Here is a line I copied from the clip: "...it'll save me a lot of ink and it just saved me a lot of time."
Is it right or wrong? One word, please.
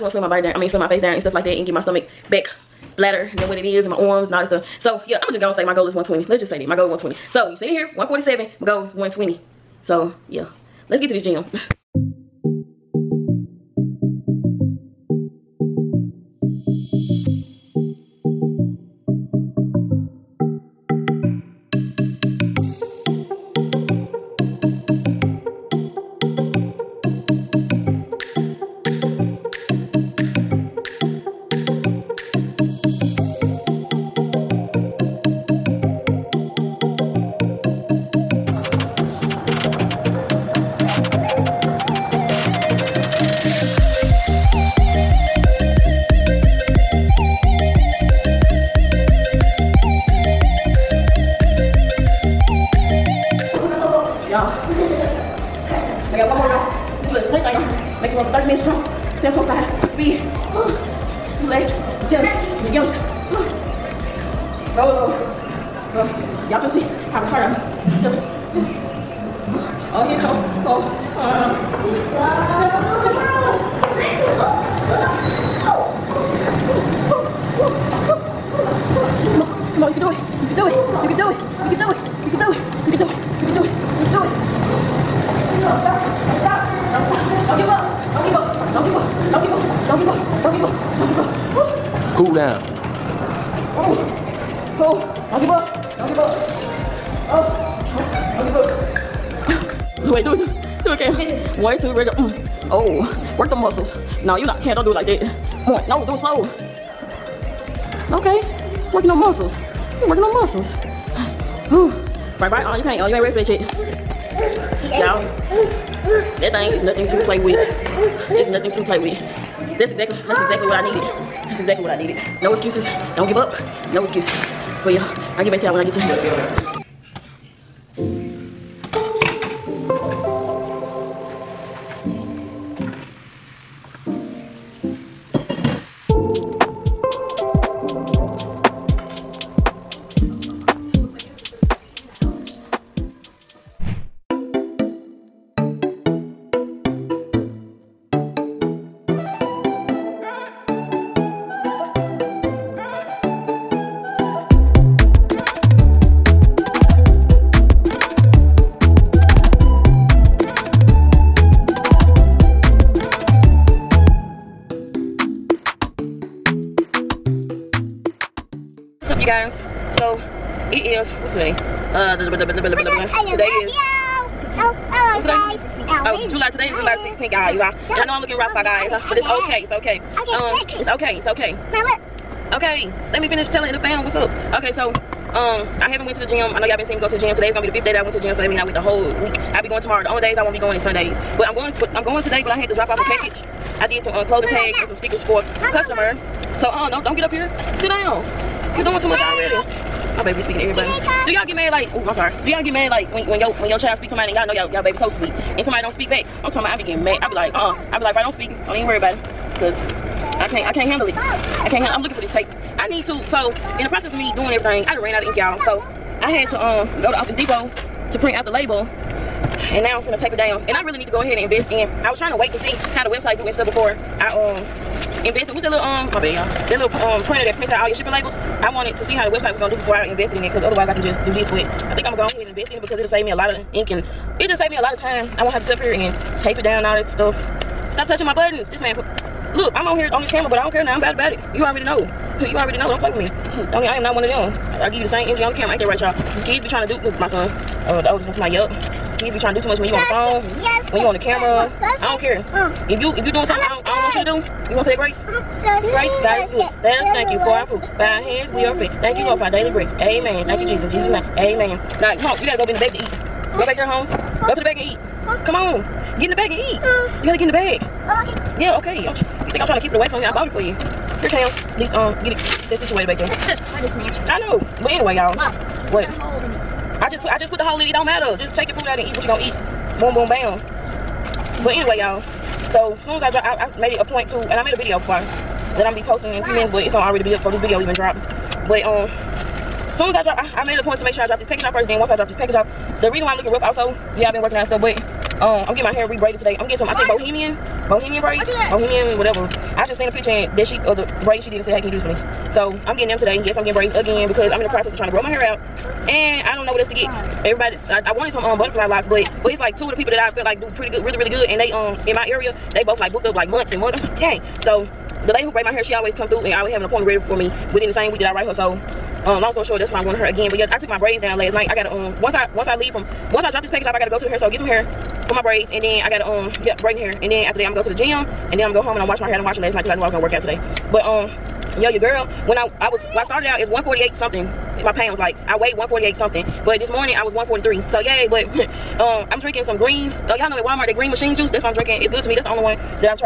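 right.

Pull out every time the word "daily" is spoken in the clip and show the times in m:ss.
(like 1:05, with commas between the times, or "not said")
4:19.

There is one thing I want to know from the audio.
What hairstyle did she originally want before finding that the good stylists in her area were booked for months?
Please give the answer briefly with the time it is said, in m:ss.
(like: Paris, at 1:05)
butterfly locks, at 5:08.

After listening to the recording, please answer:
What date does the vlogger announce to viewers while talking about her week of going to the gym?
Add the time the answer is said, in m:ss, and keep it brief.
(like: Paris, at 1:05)
July 16th, at 2:56.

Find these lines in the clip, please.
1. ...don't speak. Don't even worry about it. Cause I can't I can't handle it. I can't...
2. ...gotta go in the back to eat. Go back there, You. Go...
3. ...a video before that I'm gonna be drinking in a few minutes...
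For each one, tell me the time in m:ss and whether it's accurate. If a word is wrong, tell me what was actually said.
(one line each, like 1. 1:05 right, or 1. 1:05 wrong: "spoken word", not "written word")
1. 3:28 right
2. 4:22 wrong: "Holmes", not "You"
3. 4:44 wrong: "posting", not "drinking".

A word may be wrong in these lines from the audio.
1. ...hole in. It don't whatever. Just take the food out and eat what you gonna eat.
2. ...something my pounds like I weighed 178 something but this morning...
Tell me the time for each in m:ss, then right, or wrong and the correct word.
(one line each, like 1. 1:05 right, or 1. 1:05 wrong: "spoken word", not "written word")
1. 4:37 wrong: "matter", not "whatever"
2. 5:34 wrong: "148", not "178".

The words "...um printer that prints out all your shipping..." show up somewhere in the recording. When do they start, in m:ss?
3:47.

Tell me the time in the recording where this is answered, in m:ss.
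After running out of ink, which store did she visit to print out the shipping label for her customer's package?
3:37.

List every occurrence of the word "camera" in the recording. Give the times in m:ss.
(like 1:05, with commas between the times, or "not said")
4:00, 4:05, 4:11.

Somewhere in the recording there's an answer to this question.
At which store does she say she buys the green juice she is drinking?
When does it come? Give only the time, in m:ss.
5:40.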